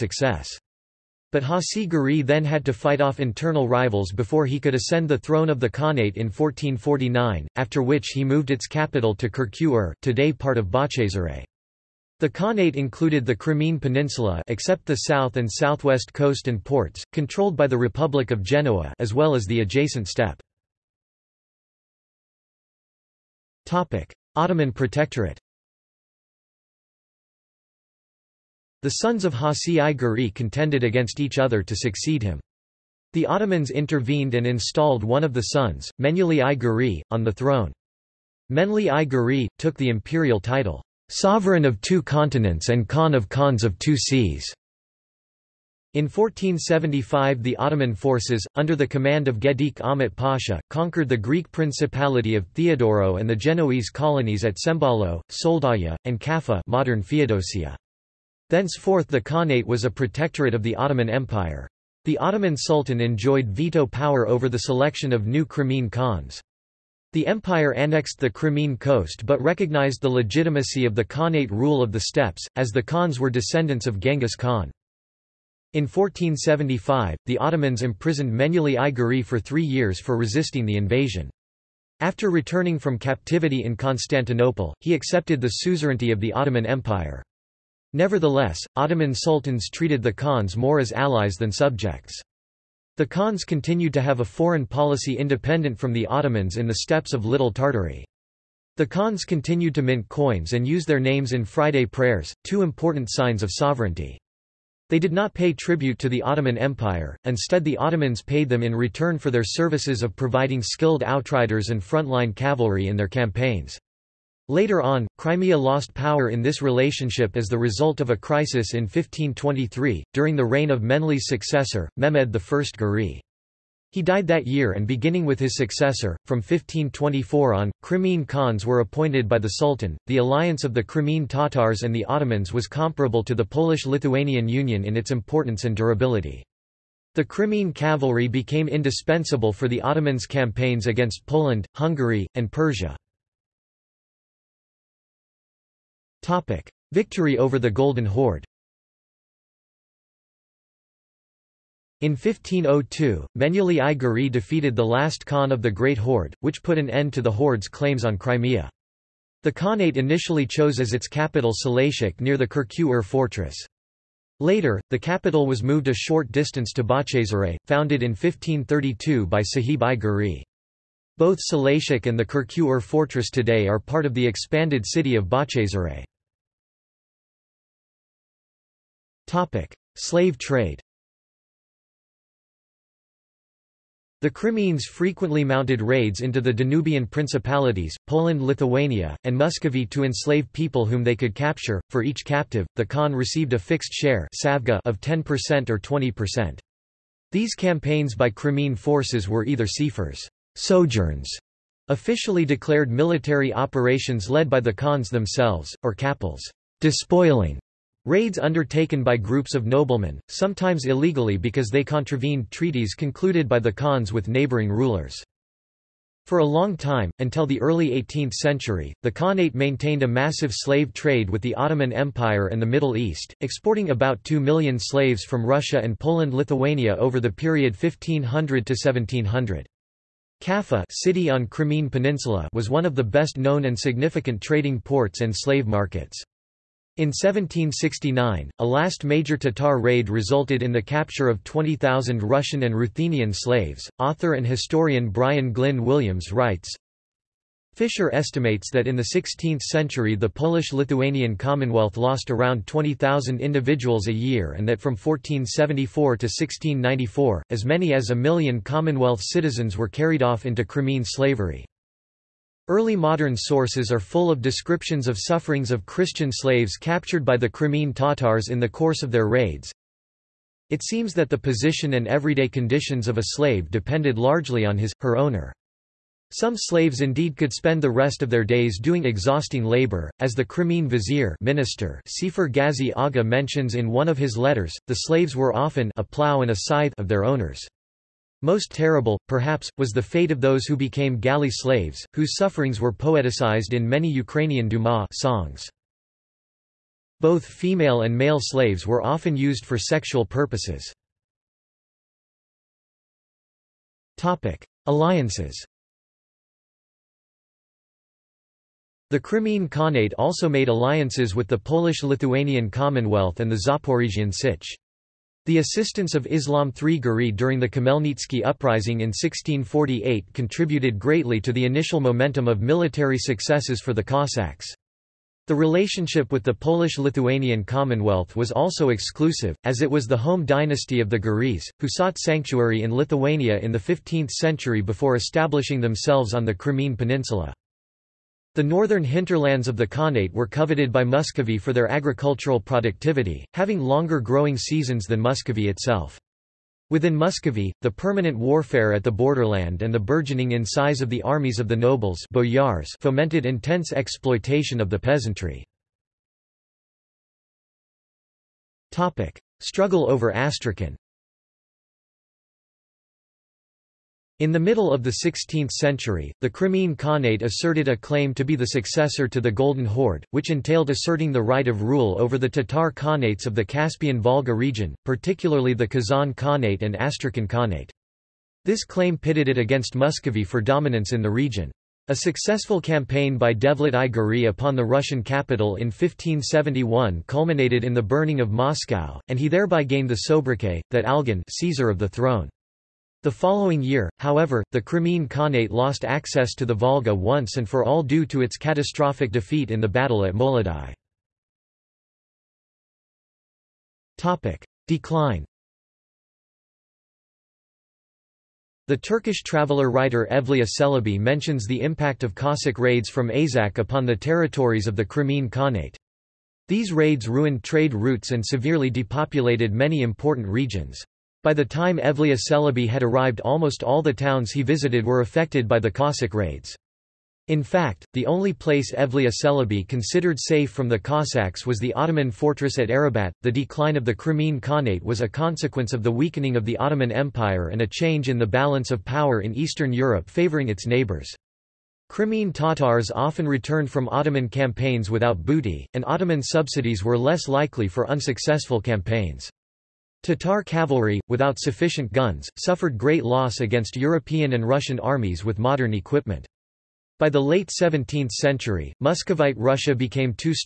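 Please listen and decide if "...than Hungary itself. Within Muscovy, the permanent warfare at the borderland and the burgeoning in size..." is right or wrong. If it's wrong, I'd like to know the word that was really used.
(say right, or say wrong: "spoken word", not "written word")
wrong: "Muscovy", not "Hungary".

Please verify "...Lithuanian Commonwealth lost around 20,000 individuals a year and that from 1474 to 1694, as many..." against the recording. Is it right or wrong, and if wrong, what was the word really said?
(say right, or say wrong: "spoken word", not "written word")
right.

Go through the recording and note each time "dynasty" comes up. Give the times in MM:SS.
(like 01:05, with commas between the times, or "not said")
05:30.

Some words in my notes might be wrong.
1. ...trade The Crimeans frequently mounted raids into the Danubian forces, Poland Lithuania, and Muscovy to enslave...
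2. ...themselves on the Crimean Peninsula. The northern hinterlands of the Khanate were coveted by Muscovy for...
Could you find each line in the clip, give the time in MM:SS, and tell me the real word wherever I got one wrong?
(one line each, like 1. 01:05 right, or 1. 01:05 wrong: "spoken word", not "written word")
1. 03:00 wrong: "principalities", not "forces"
2. 05:35 right.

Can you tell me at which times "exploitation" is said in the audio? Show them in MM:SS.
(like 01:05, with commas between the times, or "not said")
05:53.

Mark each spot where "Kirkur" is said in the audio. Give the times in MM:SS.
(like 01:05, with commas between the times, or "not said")
00:09, 02:42, 02:52.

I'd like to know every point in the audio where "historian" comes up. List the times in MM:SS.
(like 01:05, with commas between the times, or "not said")
04:04.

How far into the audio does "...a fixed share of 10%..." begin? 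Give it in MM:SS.
03:13.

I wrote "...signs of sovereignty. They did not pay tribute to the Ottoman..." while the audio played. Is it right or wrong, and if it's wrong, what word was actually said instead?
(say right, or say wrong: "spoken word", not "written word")
right.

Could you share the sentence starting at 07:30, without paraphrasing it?
Tatar cavalry, without sufficient guns, suffered great loss against European and Russian armies with modern equipment.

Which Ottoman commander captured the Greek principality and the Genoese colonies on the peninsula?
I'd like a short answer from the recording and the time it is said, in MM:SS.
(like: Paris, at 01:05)
Gedik Ahmet Pasha, at 00:49.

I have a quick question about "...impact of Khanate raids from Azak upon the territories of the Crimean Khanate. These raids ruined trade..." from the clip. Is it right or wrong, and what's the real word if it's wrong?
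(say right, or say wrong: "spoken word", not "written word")
wrong: "Cossack", not "Khanate".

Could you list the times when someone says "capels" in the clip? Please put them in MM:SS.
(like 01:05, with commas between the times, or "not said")
03:25.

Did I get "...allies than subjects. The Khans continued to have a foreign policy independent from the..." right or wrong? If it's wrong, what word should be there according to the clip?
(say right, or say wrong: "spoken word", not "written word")
right.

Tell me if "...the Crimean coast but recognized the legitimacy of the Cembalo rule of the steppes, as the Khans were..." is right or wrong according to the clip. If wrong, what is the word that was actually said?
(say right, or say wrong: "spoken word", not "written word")
wrong: "Khanate", not "Cembalo".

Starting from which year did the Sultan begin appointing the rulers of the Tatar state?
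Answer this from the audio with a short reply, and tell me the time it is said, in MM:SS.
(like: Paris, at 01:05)
1524, at 02:06.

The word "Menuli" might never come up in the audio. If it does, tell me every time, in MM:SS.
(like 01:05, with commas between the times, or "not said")
00:35, 01:18.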